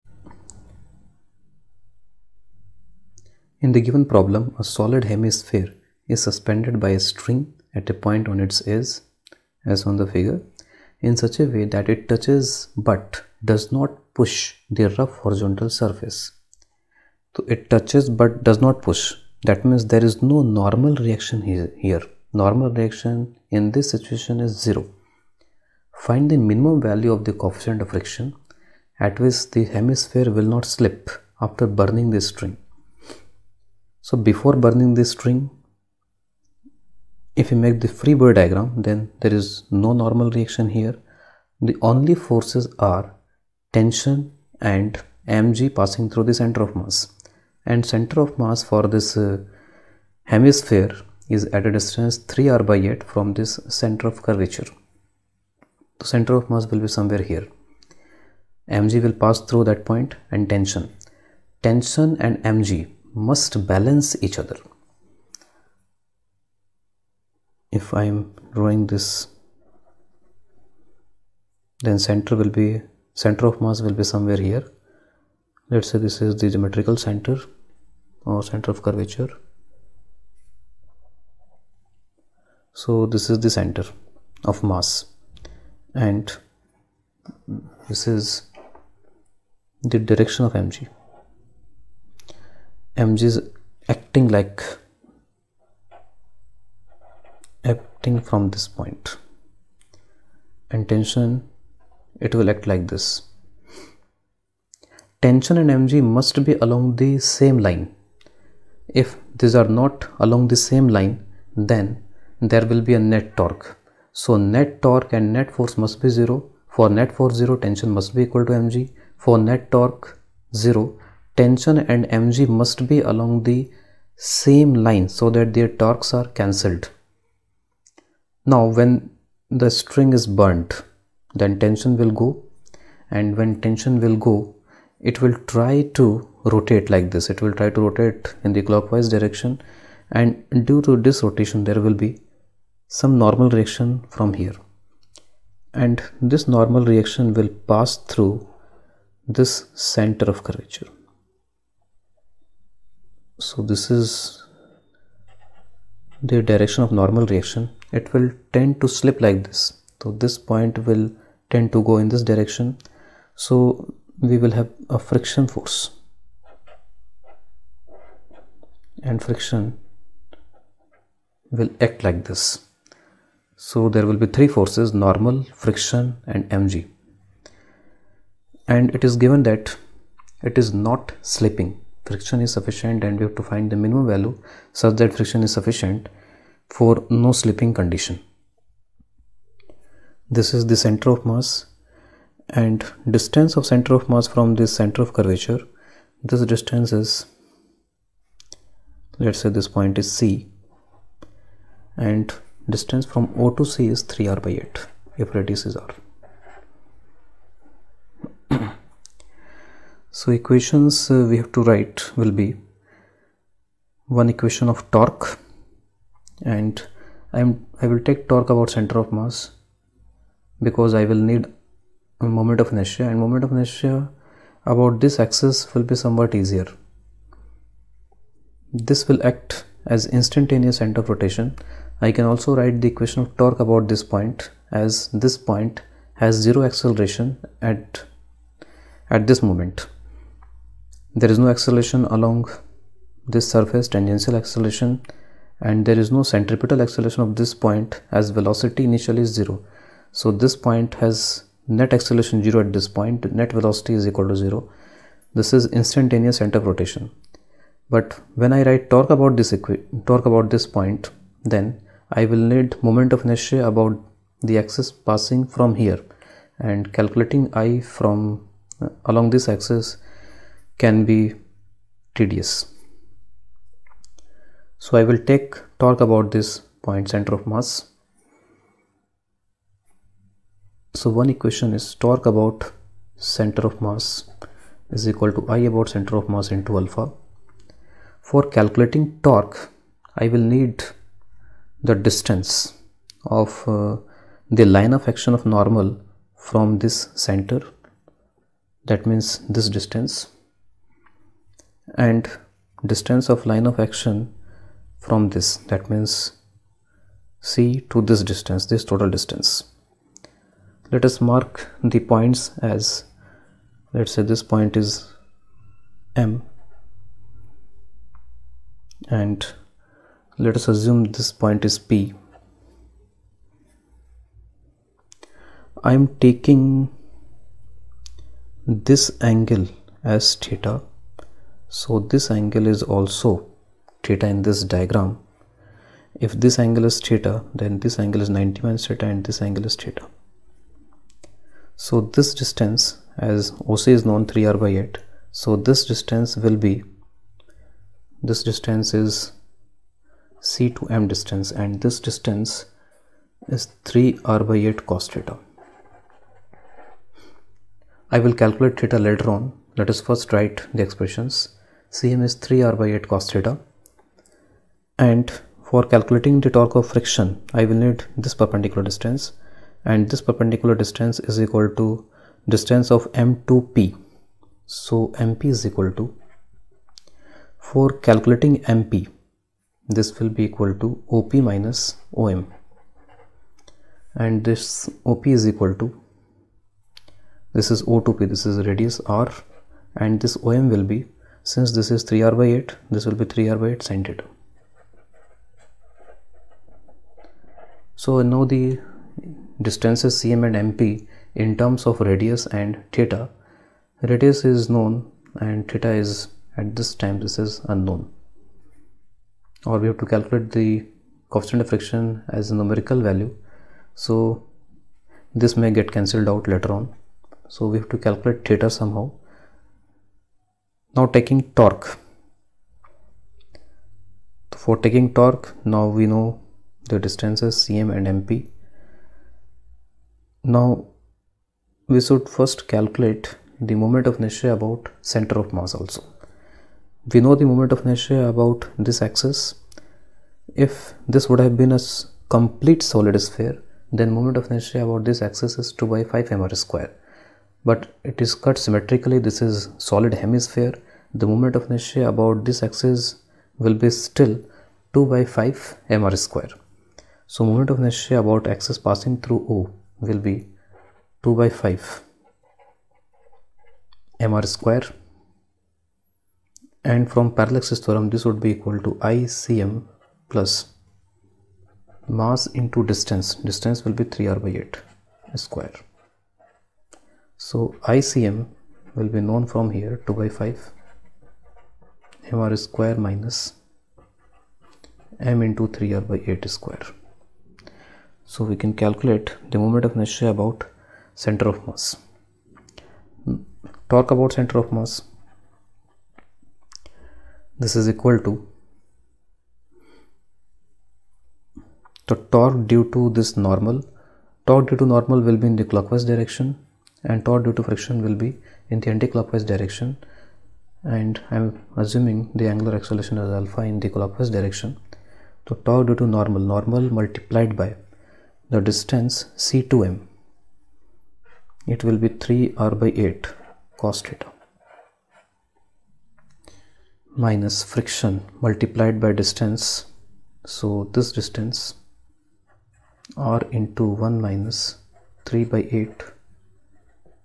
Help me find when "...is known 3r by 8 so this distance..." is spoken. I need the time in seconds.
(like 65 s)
343 s.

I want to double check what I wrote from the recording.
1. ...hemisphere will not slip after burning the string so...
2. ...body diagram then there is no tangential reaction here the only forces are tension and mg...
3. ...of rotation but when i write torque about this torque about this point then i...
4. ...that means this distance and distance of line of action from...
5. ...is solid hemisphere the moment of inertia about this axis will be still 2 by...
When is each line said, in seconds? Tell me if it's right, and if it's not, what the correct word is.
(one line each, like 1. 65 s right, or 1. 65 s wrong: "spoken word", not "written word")
1. 29 s right
2. 38 s wrong: "normal", not "tangential"
3. 256 s right
4. 298 s right
5. 449 s right.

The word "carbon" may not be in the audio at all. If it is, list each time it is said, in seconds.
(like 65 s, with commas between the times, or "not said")
not said.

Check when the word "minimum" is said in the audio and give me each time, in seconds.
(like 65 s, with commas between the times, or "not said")
26 s, 183 s.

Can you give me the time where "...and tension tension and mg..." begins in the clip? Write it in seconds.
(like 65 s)
60 s.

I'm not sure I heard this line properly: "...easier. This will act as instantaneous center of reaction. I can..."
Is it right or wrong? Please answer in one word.
wrong.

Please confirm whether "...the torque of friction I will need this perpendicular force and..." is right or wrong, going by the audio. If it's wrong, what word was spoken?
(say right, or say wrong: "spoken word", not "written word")
wrong: "distance", not "force".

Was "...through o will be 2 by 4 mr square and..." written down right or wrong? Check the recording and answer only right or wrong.
wrong.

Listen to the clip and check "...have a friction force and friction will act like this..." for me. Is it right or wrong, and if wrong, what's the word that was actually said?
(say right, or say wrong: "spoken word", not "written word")
right.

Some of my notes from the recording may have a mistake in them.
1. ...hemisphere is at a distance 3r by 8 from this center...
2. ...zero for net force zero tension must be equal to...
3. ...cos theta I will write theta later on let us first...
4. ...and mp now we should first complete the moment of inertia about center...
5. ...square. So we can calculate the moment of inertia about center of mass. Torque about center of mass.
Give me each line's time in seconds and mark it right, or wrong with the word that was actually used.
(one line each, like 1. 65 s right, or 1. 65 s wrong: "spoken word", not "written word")
1. 50 s right
2. 116 s right
3. 354 s wrong: "calculate", not "write"
4. 427 s wrong: "calculate", not "complete"
5. 486 s right.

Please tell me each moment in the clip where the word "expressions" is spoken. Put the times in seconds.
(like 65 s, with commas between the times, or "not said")
360 s.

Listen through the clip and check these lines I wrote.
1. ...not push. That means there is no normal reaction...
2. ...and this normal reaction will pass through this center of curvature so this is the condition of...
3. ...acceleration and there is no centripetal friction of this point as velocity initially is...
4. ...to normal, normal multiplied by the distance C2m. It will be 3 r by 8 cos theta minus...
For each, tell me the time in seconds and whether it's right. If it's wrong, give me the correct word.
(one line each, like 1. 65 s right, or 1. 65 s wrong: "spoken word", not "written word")
1. 18 s right
2. 145 s wrong: "direction", not "condition"
3. 244 s wrong: "acceleration", not "friction"
4. 515 s right.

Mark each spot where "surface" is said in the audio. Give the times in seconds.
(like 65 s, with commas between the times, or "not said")
15 s, 243 s.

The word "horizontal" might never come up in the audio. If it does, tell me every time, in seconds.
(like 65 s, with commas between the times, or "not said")
15 s.